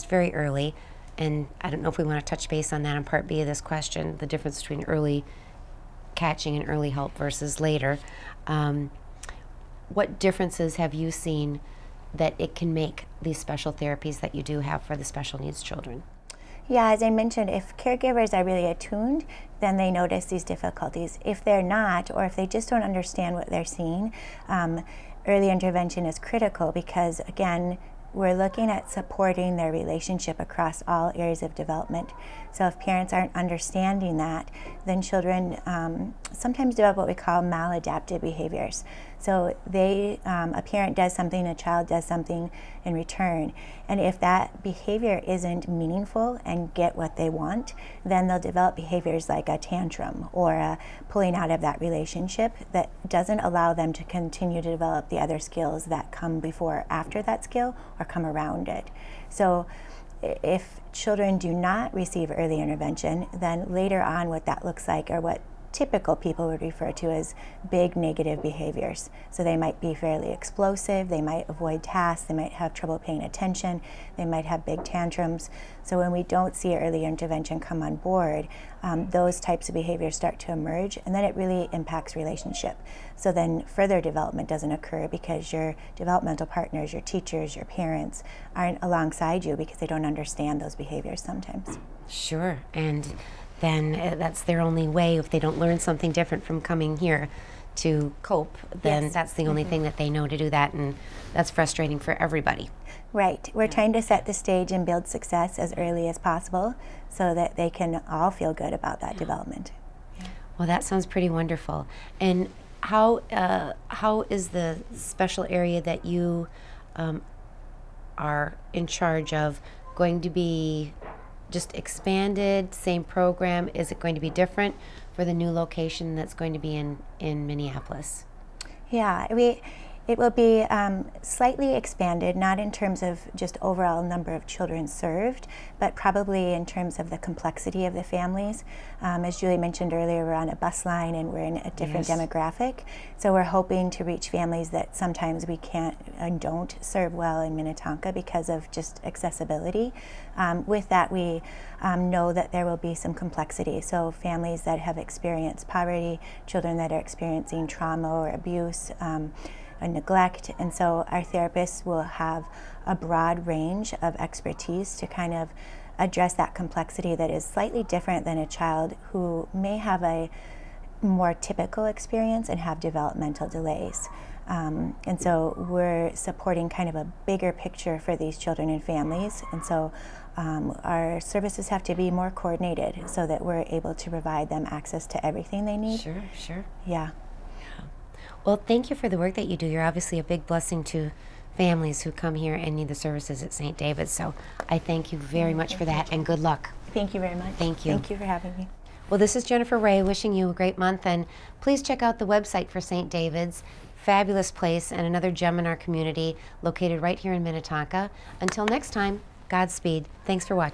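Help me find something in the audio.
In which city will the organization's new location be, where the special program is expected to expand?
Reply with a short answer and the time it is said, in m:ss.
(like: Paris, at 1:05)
Minneapolis, at 2:07.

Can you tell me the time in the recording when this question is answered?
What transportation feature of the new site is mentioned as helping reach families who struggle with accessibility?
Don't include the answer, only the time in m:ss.
2:20.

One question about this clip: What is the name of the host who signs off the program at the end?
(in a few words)
Jennifer Ray.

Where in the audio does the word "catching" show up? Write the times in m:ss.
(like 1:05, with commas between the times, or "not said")
0:06.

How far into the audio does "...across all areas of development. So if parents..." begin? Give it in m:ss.
0:30.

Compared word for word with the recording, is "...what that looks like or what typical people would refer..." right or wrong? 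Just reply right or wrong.
right.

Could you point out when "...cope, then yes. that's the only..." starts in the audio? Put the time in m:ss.
1:38.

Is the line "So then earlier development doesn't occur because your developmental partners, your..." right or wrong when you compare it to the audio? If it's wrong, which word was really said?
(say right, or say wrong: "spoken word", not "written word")
wrong: "further", not "earlier".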